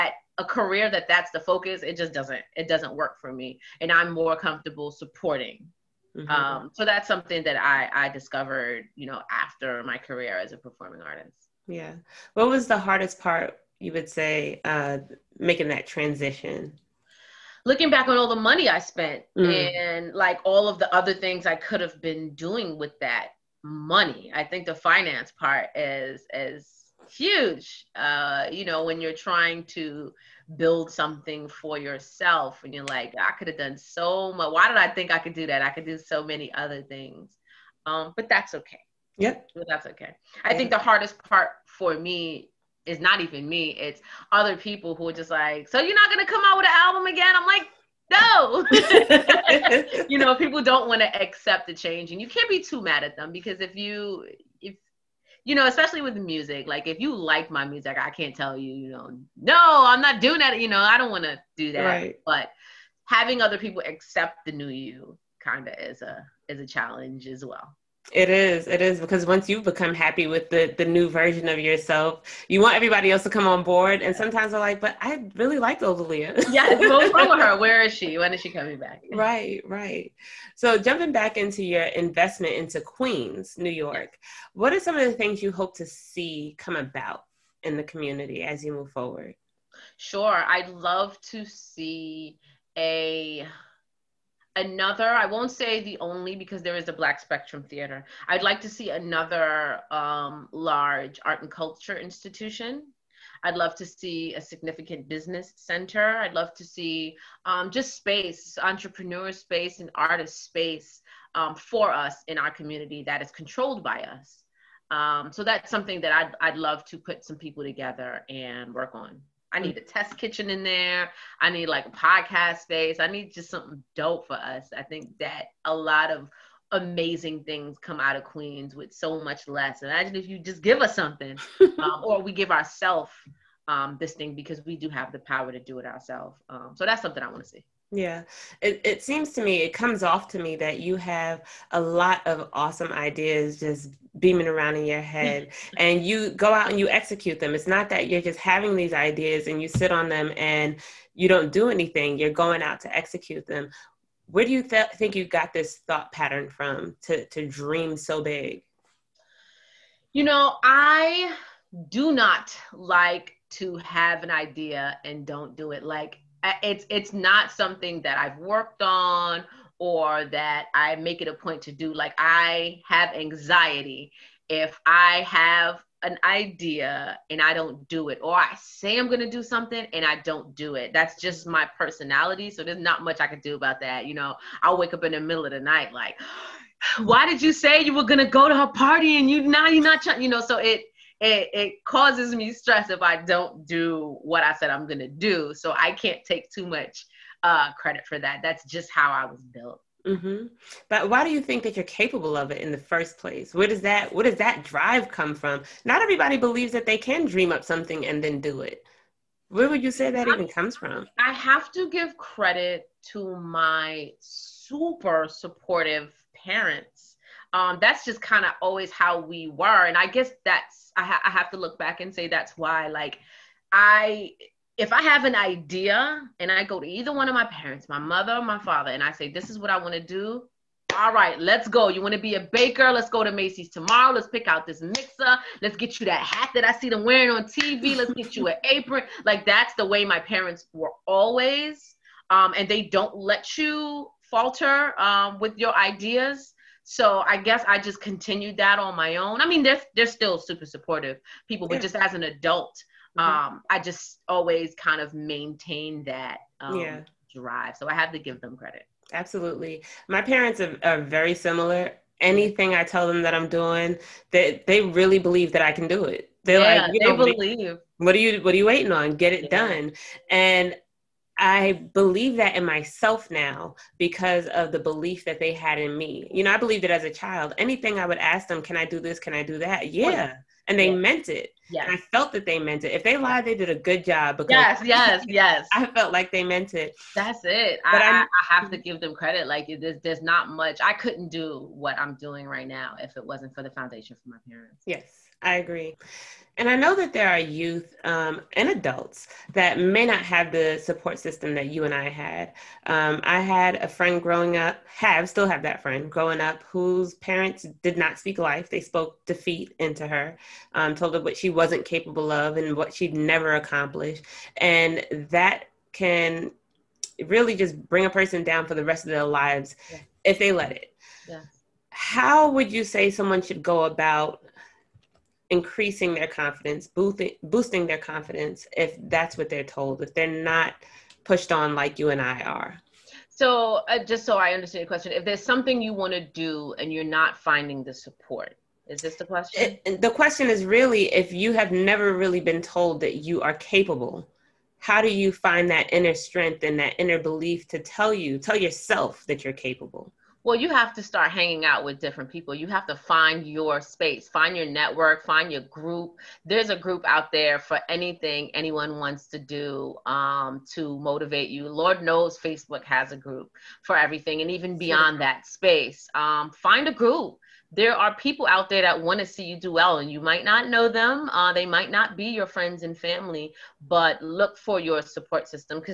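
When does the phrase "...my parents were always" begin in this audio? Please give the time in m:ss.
4:00.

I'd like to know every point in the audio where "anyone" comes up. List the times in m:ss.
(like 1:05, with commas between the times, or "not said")
5:58.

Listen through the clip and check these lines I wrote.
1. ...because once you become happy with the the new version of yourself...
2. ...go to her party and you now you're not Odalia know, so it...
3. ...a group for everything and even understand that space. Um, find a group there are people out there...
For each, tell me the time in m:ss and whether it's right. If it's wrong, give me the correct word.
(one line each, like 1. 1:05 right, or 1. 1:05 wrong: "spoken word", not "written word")
1. 1:08 right
2. 3:08 wrong: "You", not "Odalia"
3. 6:03 wrong: "beyond", not "understand".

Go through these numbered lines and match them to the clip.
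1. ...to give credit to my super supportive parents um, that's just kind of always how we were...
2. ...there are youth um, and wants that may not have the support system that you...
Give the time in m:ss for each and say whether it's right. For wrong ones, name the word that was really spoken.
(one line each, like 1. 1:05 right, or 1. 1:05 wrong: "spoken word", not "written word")
1. 3:31 right
2. 4:57 wrong: "adults", not "wants".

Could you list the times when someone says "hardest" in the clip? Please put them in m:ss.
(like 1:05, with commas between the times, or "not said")
0:12, 0:40.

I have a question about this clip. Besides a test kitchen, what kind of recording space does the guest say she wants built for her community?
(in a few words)
Podcast space.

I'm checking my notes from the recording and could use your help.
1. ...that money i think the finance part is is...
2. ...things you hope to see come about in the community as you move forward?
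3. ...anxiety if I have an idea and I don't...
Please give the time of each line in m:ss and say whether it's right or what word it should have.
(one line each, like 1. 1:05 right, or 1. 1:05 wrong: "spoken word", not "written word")
1. 0:22 right
2. 1:25 right
3. 2:53 right.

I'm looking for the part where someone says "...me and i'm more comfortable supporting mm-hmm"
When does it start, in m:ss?
0:03.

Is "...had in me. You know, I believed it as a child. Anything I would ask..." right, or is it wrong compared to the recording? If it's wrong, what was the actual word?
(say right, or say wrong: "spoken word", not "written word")
right.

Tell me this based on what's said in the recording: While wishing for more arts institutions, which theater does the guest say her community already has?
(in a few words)
Black Spectrum Theater.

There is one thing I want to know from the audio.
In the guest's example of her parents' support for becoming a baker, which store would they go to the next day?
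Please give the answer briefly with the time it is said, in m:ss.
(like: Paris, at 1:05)
Macy's, at 3:53.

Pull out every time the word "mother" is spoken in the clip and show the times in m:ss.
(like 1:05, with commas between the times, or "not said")
3:47.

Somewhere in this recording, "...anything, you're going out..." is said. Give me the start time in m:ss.
2:31.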